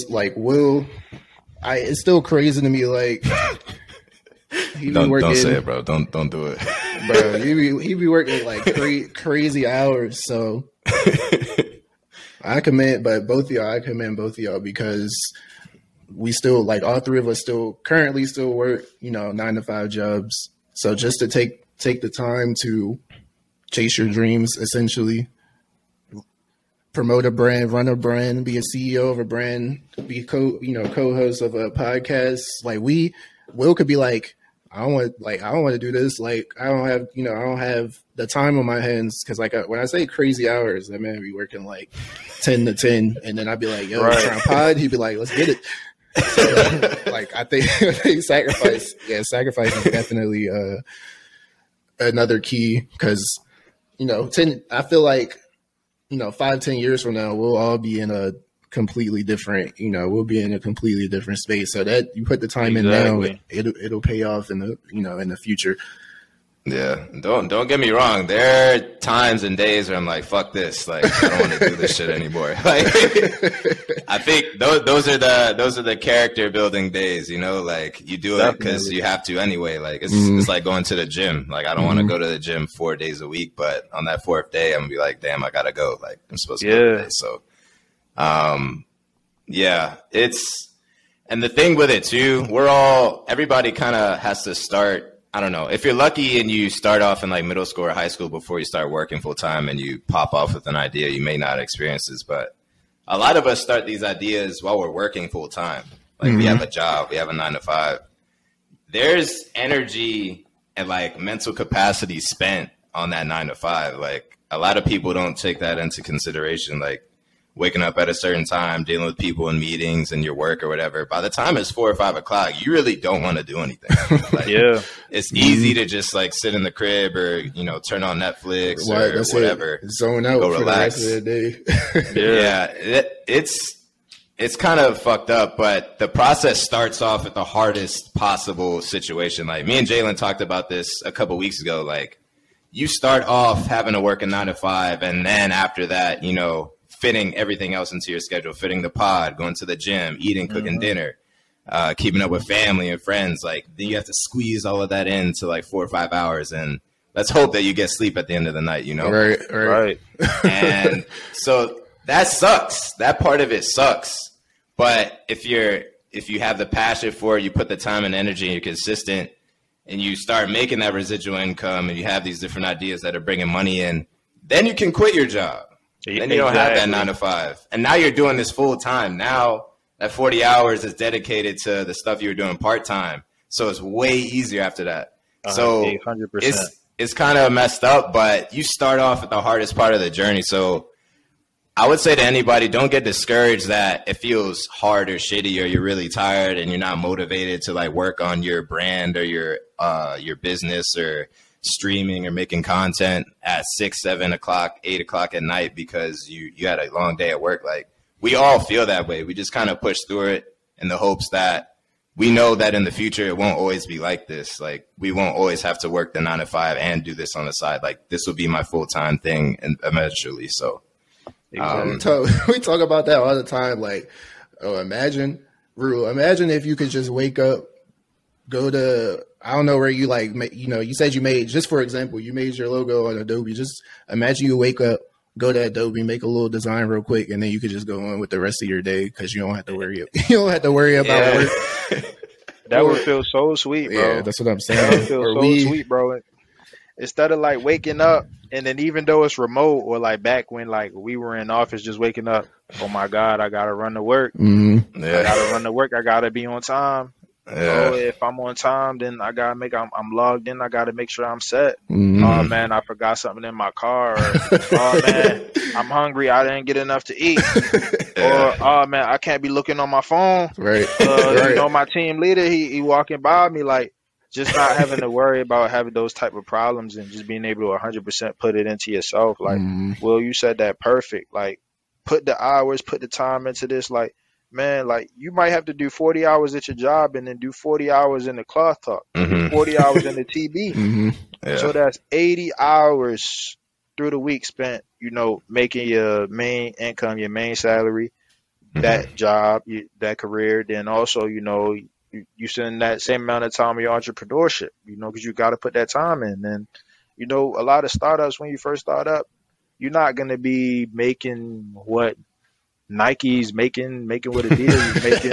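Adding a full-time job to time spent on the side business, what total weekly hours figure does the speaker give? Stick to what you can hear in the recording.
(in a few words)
80 hours.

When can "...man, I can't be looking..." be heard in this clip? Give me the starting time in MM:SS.
04:28.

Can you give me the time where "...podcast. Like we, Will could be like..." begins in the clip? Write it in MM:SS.
00:31.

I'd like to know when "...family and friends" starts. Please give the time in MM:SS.
02:32.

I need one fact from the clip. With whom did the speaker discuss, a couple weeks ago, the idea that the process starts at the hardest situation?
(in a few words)
Jalen.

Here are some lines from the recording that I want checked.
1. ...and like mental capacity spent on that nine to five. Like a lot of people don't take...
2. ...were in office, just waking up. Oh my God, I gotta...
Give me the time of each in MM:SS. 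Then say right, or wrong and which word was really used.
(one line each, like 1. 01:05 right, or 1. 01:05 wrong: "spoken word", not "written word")
1. 01:50 right
2. 04:11 right.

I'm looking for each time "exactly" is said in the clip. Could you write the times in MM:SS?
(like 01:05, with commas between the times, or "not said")
01:02, 02:56.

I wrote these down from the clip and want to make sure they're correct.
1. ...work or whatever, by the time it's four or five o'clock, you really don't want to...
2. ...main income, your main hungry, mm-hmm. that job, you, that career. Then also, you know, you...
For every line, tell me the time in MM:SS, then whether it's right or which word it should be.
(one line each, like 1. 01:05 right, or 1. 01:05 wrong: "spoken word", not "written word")
1. 02:00 right
2. 04:56 wrong: "salary", not "hungry".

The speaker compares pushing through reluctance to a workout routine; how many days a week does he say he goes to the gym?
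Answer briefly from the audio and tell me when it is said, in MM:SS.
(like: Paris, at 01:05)
4, at 01:22.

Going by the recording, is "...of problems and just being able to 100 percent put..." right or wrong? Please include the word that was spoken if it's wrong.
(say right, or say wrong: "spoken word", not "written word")
right.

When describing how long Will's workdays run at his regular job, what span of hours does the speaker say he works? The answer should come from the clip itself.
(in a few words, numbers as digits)
10 to 10.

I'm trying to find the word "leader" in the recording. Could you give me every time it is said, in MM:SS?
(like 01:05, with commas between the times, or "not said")
04:32.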